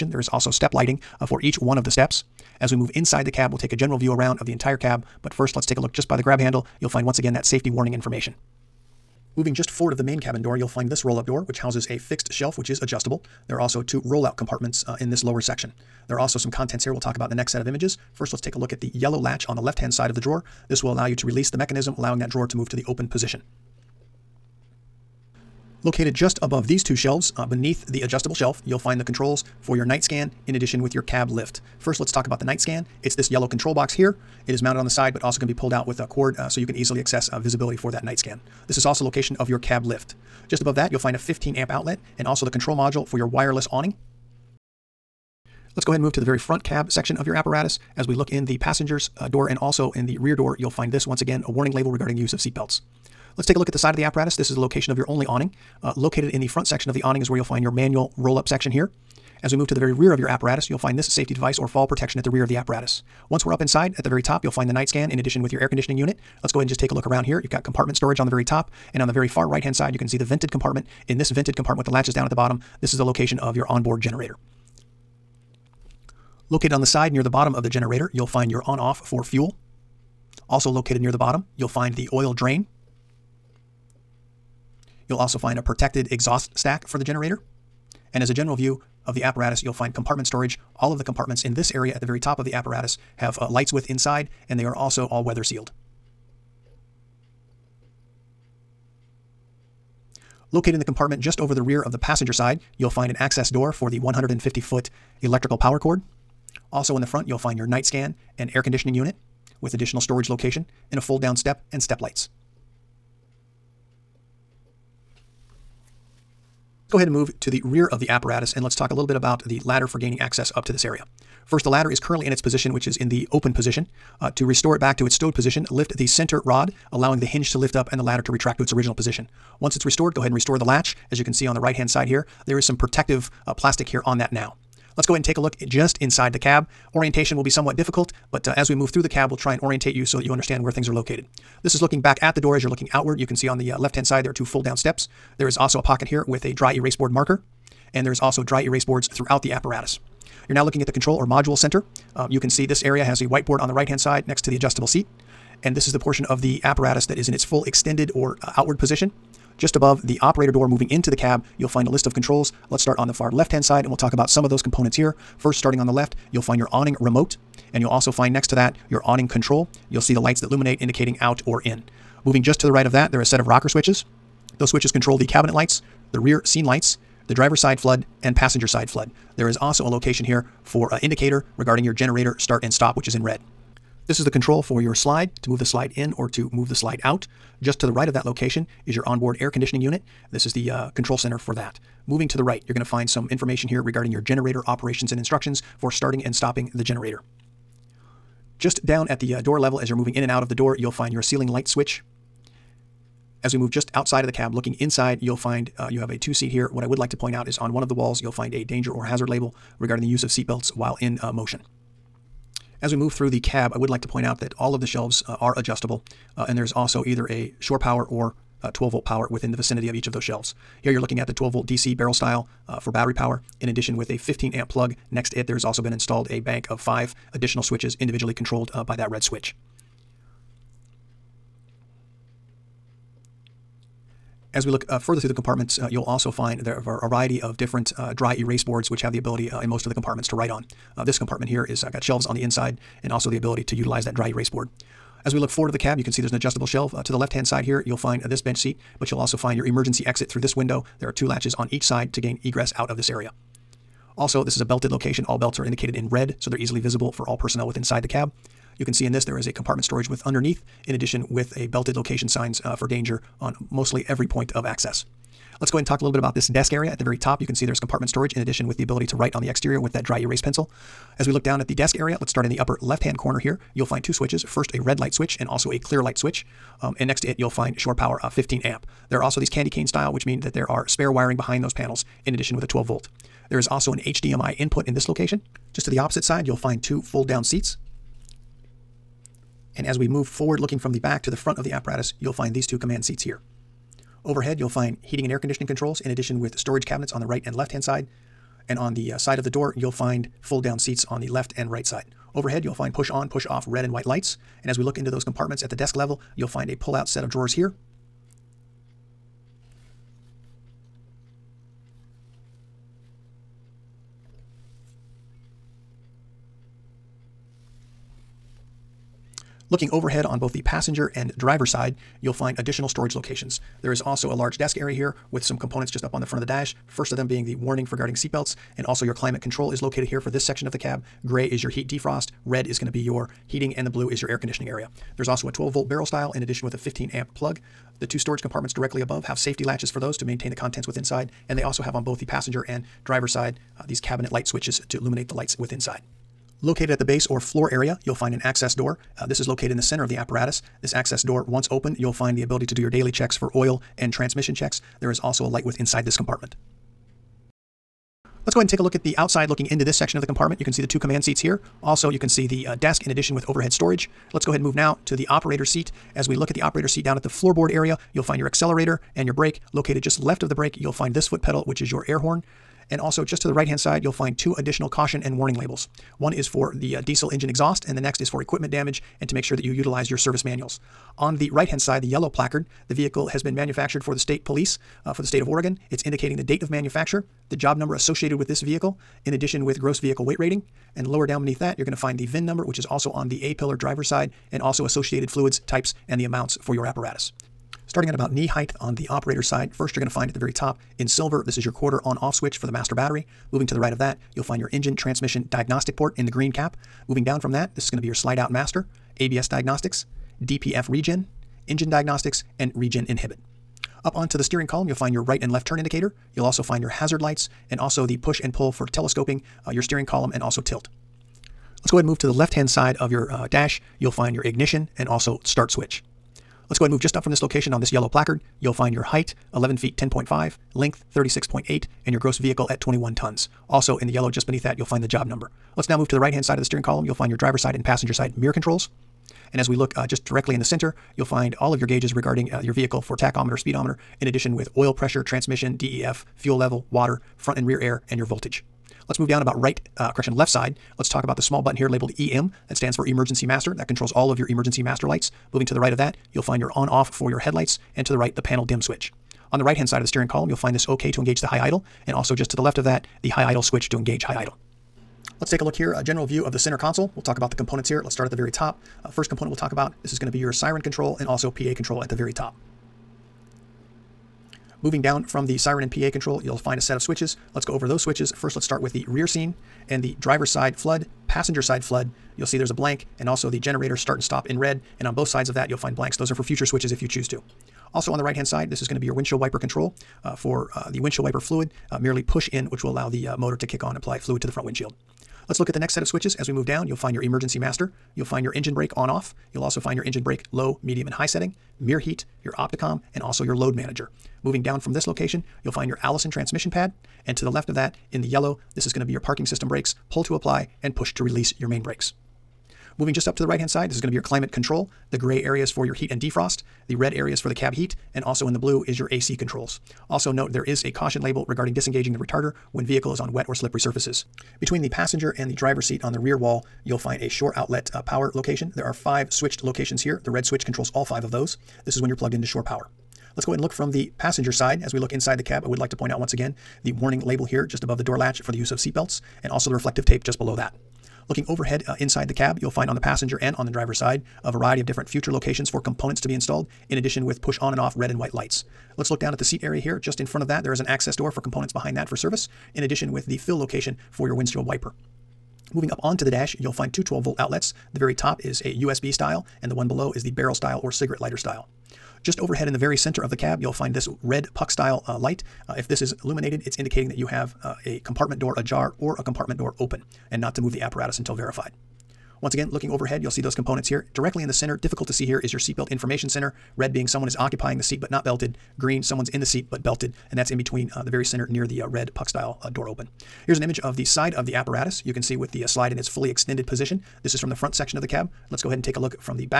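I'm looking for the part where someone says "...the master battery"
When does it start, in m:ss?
6:42.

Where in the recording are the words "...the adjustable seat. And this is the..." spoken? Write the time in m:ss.
2:34.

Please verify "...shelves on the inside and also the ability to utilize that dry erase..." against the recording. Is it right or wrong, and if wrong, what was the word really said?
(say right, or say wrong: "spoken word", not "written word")
right.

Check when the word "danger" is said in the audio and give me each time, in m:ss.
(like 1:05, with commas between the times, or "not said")
3:28, 4:22.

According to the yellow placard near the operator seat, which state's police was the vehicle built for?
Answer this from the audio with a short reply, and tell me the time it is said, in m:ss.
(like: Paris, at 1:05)
Oregon, at 6:25.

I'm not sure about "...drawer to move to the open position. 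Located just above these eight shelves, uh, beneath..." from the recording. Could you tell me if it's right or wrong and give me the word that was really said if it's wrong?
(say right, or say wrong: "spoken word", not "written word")
wrong: "two", not "eight".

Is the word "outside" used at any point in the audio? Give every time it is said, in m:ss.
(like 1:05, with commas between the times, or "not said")
3:23, 5:59.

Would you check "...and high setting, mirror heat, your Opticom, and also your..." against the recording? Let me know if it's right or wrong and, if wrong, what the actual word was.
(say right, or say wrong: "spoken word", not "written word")
right.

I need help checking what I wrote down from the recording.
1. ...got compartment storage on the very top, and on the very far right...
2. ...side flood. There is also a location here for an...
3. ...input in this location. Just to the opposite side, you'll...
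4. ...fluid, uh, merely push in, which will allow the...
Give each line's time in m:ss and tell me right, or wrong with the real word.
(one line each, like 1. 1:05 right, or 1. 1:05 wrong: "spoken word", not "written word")
1. 1:07 right
2. 2:58 right
3. 4:44 right
4. 8:11 right.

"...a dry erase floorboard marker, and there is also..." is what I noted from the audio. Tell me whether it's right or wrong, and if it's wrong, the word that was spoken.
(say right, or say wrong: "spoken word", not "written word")
wrong: "board", not "floorboard".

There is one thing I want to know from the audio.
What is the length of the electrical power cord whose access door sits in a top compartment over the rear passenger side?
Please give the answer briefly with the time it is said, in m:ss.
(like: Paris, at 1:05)
150 foot, at 1:43.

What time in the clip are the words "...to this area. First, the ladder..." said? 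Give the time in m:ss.
2:00.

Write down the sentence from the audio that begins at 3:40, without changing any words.
Here you're looking at the 12 volt DC barrel style uh, for battery power.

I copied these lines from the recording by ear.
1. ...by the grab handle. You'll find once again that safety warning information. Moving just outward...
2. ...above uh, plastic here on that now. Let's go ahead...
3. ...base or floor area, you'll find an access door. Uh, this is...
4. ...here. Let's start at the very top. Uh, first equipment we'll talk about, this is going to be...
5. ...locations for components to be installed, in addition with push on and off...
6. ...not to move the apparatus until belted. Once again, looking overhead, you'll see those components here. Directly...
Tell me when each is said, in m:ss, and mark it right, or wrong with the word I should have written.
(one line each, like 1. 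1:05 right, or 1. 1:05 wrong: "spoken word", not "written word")
1. 0:06 wrong: "forward", not "outward"
2. 2:12 wrong: "protective", not "above"
3. 5:47 right
4. 7:47 wrong: "component", not "equipment"
5. 9:05 right
6. 9:30 wrong: "verified", not "belted".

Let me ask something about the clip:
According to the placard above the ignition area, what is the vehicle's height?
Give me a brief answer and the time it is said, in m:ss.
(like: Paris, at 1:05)
11 feet 10.5, at 7:09.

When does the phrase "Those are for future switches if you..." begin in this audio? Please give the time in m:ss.
8:06.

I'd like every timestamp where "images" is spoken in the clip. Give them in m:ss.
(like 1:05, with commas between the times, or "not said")
0:17, 9:43.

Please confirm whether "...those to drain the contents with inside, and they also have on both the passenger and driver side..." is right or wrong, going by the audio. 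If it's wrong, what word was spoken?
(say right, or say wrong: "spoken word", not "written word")
wrong: "maintain", not "drain".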